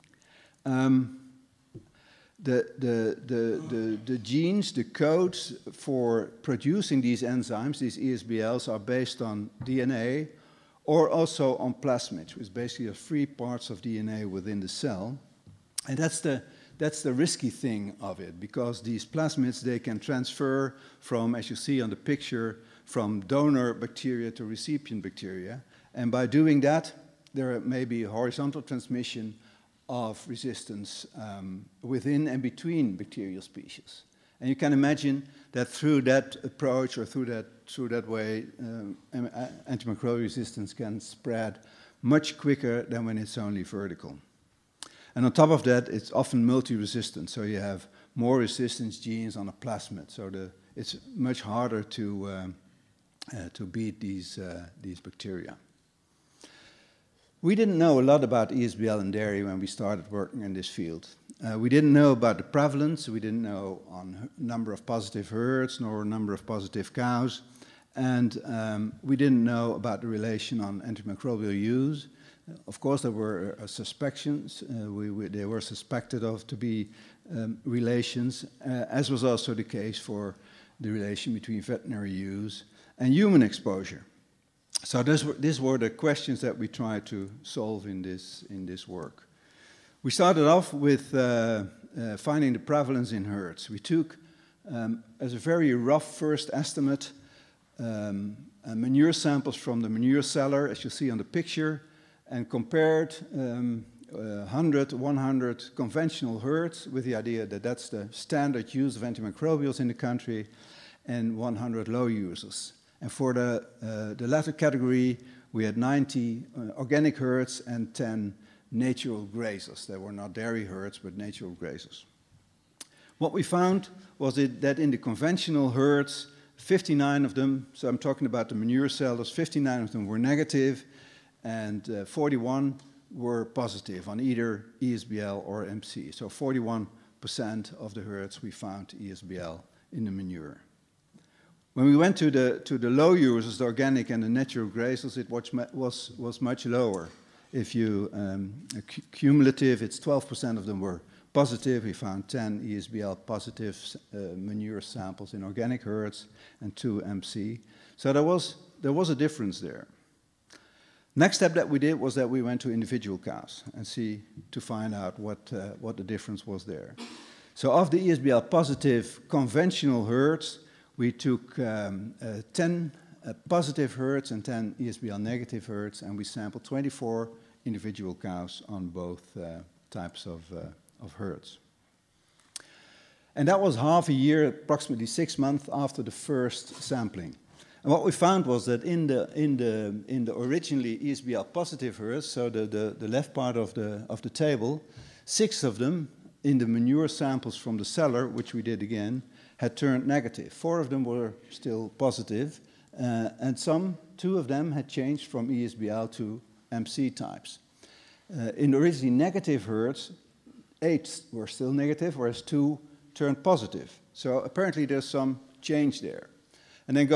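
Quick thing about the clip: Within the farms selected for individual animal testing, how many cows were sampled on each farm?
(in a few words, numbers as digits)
24.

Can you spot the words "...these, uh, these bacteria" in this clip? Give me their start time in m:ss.
0:54.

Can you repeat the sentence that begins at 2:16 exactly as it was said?
So 41% of the herds we found ESBL in the manure.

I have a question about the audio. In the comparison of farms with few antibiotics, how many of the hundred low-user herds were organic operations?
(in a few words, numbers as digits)
90.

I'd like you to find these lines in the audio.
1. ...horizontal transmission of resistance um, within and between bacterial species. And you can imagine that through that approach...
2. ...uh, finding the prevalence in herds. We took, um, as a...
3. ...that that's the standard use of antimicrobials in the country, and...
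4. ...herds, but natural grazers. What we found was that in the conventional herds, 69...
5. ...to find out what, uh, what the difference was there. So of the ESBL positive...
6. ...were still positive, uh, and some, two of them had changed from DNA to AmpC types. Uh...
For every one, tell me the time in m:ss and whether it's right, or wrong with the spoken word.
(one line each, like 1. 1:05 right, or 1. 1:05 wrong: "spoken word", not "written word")
1. 0:28 right
2. 1:31 right
3. 1:47 right
4. 2:00 wrong: "59", not "69"
5. 2:44 right
6. 3:21 wrong: "ESBL", not "DNA".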